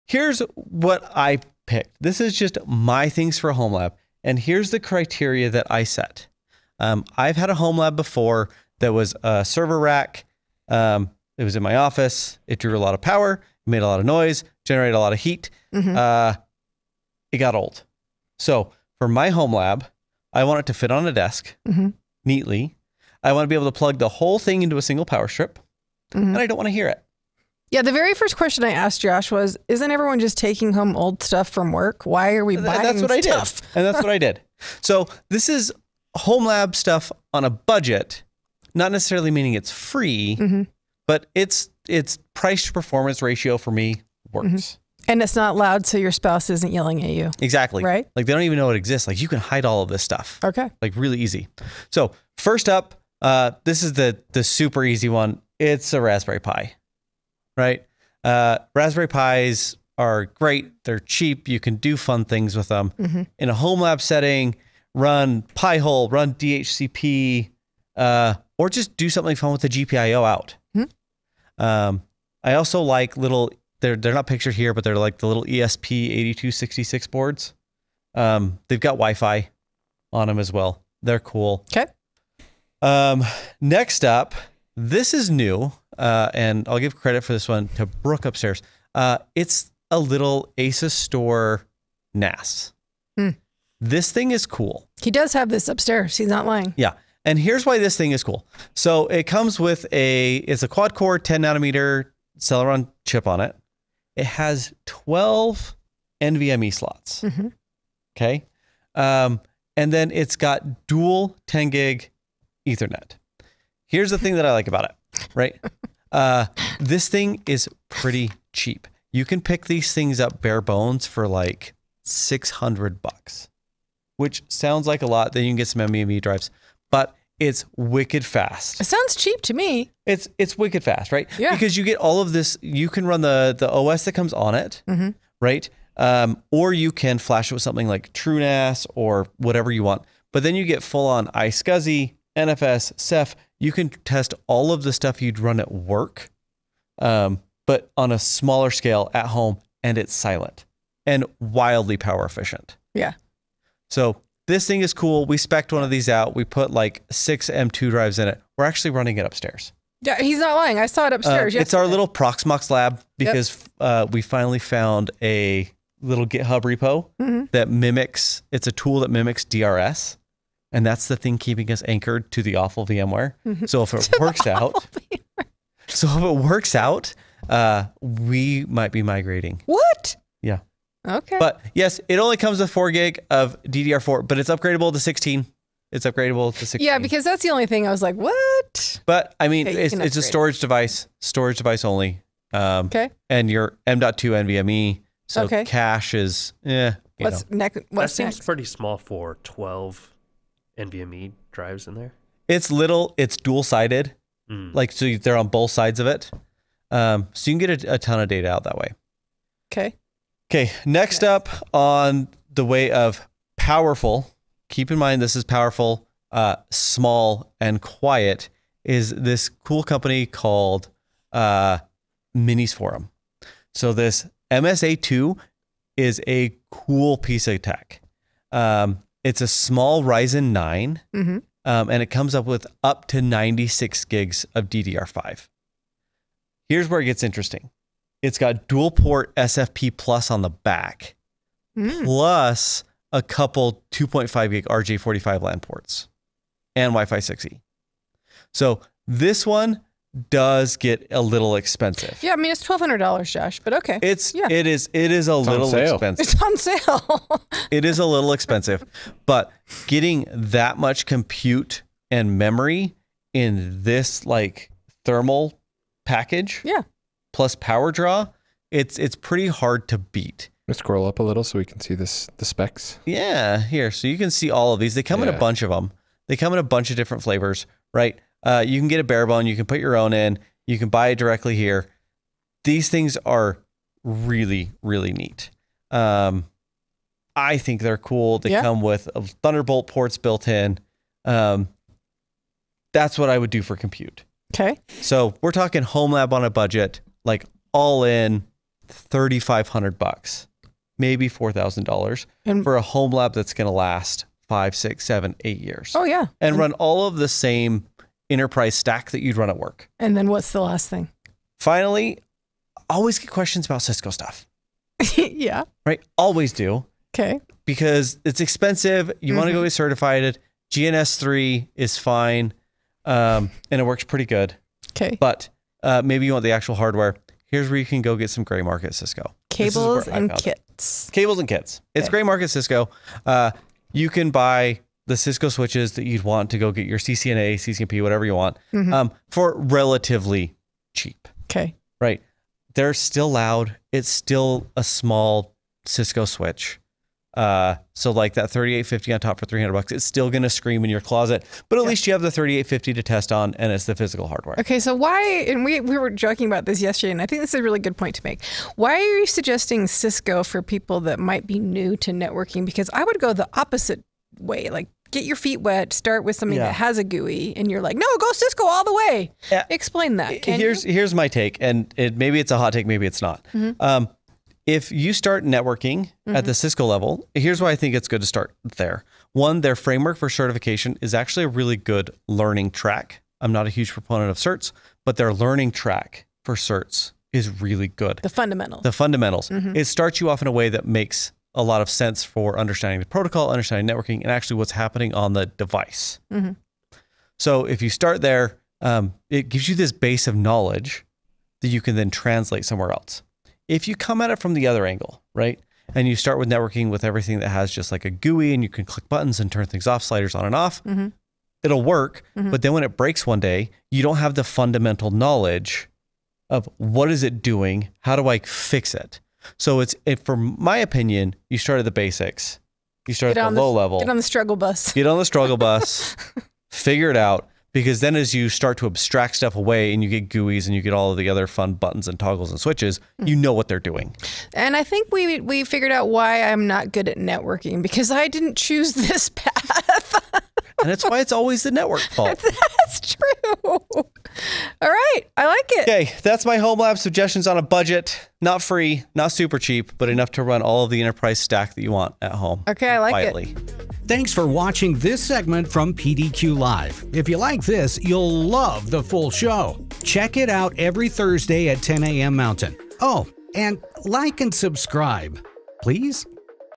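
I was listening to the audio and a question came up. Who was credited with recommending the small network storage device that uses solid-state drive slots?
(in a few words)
Brooke.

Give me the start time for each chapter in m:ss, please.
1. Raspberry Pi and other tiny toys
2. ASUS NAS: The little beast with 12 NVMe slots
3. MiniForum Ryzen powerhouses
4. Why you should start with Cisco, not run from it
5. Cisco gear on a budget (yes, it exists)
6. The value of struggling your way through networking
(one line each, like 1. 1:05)
1. 0:55
2. 1:44
3. 3:16
4. 6:17
5. 5:23
6. 7:14.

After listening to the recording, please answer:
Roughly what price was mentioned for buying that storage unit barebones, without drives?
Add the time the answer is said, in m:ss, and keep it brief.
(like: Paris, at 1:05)
$600, at 2:02.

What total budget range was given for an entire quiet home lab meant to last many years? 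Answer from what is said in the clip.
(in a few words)
$3,500 to $4,000.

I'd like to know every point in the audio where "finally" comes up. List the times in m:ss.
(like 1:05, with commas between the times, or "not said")
2:44, 5:11.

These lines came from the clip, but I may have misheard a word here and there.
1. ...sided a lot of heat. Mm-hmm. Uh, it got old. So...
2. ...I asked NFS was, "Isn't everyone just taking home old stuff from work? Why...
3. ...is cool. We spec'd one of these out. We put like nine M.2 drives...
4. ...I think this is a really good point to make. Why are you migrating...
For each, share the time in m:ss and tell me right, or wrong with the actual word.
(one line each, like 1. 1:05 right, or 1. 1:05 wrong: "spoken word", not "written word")
1. 0:14 wrong: "generated", not "sided"
2. 0:28 wrong: "Josh", not "NFS"
3. 2:34 wrong: "six", not "nine"
4. 5:57 wrong: "suggesting", not "migrating".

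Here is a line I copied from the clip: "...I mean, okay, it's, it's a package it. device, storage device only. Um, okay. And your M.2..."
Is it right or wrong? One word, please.
wrong.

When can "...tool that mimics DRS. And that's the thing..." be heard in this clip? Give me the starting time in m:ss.
2:48.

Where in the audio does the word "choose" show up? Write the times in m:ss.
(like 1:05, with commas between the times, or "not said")
7:18.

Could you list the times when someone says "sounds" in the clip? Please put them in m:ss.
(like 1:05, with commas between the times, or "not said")
2:04, 2:08.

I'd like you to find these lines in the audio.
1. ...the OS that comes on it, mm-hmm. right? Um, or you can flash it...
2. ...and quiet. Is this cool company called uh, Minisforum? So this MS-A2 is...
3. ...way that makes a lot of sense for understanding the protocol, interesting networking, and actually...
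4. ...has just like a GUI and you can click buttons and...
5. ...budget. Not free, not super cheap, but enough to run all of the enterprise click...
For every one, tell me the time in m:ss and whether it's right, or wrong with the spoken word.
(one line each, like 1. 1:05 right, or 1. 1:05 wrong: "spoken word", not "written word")
1. 2:13 right
2. 3:37 right
3. 6:30 wrong: "understanding", not "interesting"
4. 6:47 right
5. 7:27 wrong: "stack", not "click".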